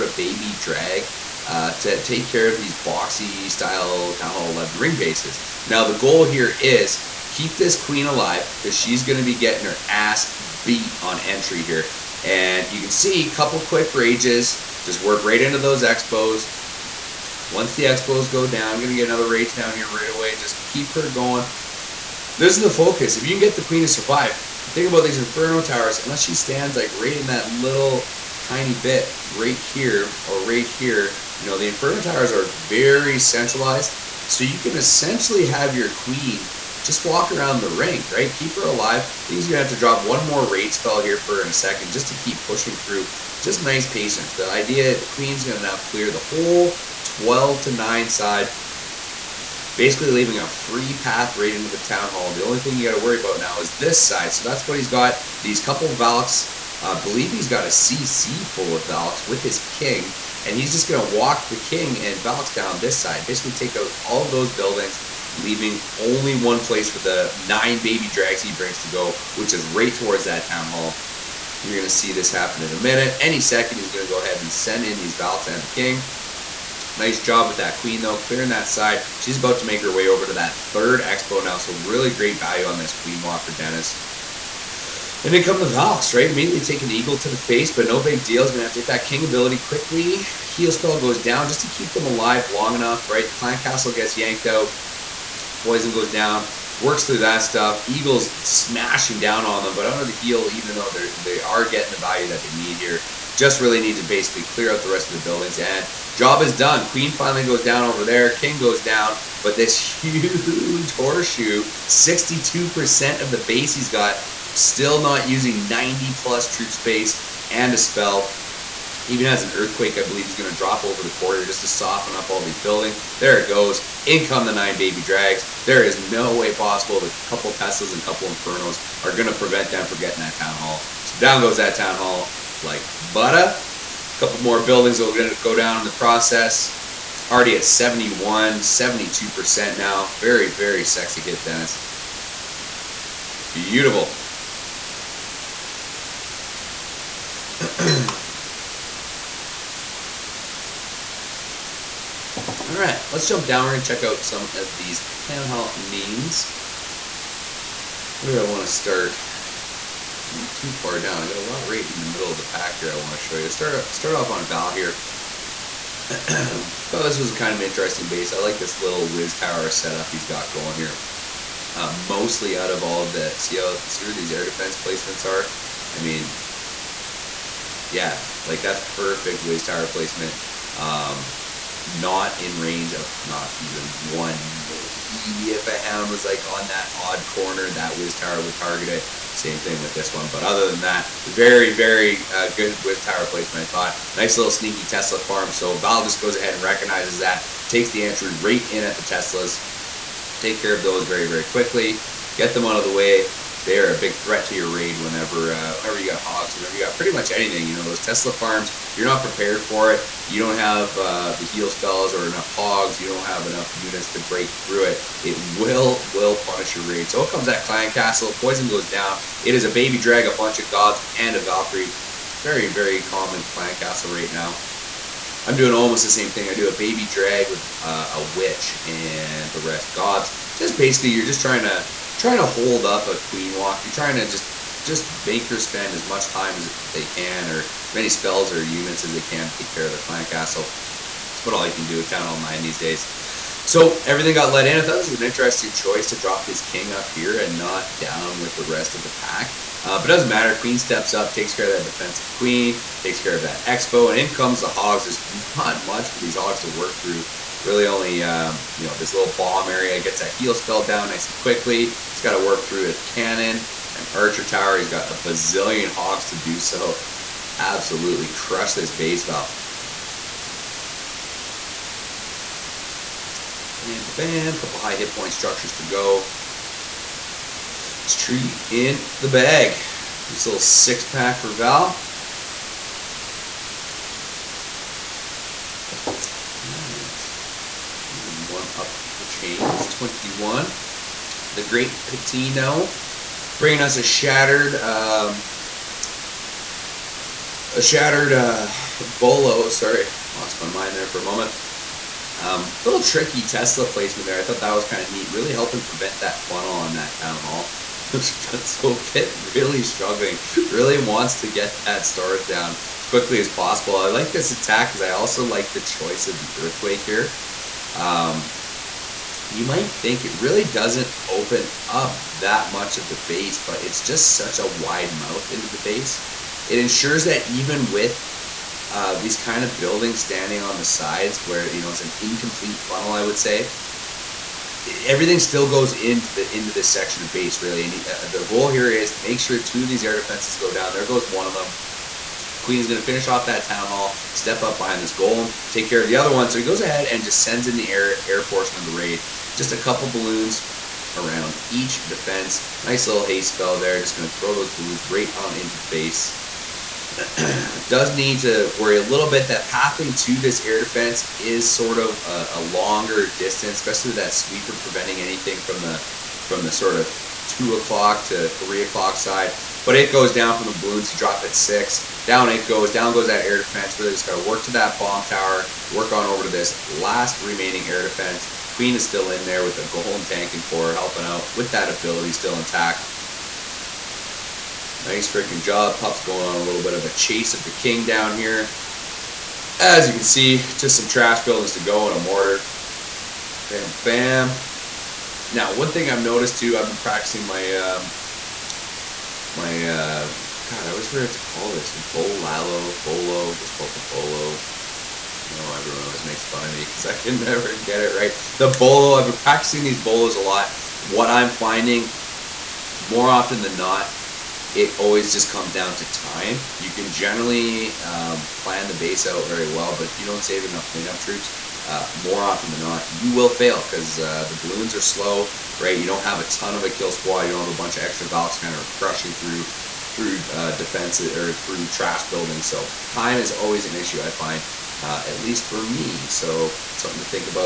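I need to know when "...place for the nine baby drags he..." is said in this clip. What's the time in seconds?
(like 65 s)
66 s.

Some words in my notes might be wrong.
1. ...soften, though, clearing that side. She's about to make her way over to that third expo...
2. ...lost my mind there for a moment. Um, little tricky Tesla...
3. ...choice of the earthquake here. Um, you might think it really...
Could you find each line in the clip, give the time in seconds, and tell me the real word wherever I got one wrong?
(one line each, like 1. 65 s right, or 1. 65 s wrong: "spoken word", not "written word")
1. 77 s wrong: "queen", not "soften"
2. 300 s right
3. 315 s right.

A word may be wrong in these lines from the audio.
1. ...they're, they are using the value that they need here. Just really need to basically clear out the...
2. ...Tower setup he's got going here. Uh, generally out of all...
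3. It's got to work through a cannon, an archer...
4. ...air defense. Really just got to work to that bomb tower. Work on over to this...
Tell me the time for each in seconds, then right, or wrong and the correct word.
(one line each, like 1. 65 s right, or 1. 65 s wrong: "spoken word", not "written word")
1. 100 s wrong: "getting", not "using"
2. 169 s wrong: "mostly", not "generally"
3. 261 s right
4. 373 s right.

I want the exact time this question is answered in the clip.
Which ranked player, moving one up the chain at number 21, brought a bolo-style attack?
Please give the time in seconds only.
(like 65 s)
291 s.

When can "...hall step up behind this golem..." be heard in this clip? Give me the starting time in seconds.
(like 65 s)
343 s.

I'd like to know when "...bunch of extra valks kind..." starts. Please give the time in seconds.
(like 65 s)
427 s.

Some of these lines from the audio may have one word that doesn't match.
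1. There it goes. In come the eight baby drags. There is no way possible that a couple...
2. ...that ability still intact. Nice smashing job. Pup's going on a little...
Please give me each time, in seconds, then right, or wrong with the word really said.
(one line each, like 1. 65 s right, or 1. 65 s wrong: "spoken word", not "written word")
1. 123 s wrong: "nine", not "eight"
2. 381 s wrong: "freaking", not "smashing".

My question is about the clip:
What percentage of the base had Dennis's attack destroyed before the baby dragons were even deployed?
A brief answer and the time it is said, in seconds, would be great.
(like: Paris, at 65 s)
62%, at 111 s.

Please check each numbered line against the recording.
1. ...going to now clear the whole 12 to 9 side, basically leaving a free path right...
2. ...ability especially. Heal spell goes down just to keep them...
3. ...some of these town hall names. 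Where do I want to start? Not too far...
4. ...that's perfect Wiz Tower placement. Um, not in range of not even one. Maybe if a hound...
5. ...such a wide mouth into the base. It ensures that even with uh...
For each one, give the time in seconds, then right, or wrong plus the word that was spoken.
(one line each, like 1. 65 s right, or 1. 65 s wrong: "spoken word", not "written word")
1. 45 s right
2. 89 s wrong: "quickly", not "especially"
3. 154 s right
4. 178 s right
5. 324 s right.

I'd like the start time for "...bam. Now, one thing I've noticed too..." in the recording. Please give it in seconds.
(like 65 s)
394 s.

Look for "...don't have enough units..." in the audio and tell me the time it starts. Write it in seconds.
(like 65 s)
213 s.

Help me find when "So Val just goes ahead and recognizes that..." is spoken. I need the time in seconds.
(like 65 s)
195 s.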